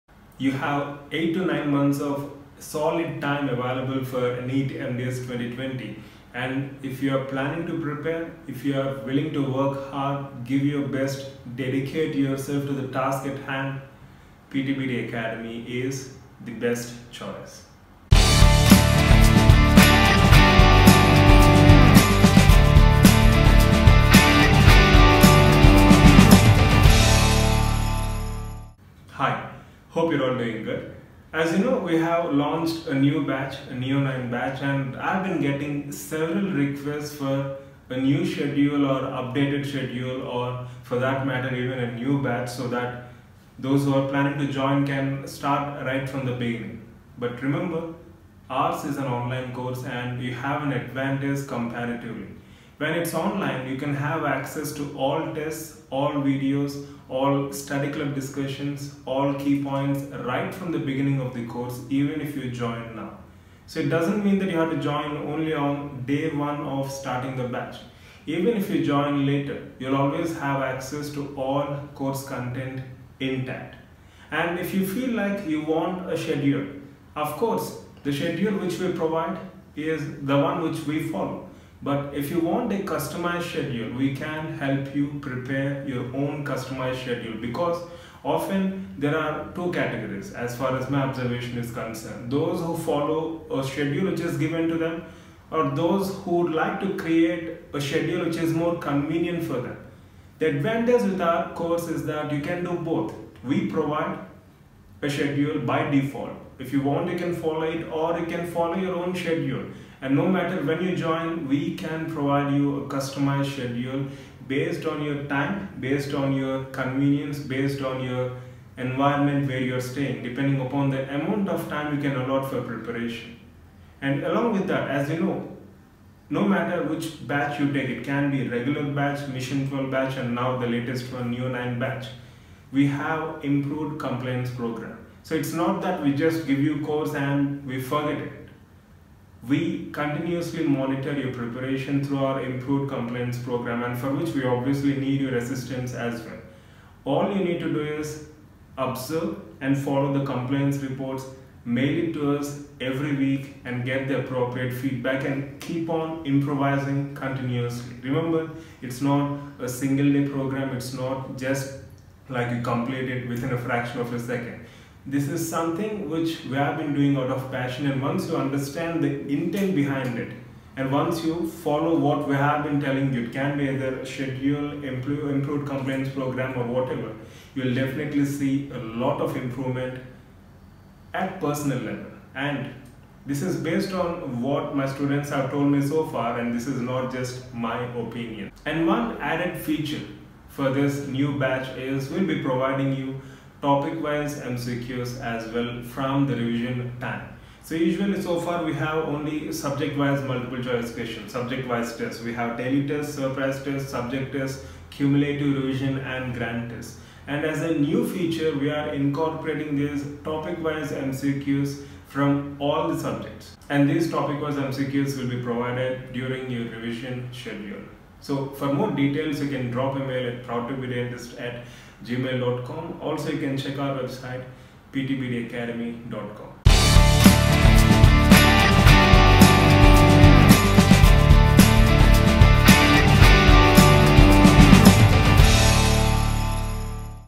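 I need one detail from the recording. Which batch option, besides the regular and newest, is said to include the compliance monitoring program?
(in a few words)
Mission 12 batch.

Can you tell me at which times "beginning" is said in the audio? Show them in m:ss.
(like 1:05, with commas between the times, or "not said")
0:46, 1:00.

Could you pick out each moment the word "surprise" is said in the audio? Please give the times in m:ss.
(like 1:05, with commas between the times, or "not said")
3:23.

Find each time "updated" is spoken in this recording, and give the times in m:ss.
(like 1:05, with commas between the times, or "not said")
0:39.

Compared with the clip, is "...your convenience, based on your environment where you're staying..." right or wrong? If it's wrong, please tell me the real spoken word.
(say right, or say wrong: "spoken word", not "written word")
right.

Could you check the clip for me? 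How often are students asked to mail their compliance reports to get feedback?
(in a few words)
Every week.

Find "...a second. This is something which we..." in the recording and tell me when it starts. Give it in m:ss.
2:44.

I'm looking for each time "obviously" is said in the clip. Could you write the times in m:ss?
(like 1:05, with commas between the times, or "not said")
2:24.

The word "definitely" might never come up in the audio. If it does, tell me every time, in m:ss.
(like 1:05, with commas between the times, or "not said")
2:57.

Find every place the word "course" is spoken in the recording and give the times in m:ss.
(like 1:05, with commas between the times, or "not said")
0:49, 1:01, 1:12, 1:17, 1:41, 2:16.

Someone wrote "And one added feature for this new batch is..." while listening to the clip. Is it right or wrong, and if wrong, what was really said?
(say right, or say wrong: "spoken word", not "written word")
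right.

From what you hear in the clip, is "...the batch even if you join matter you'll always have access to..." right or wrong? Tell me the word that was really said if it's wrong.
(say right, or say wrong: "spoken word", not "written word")
wrong: "later", not "matter".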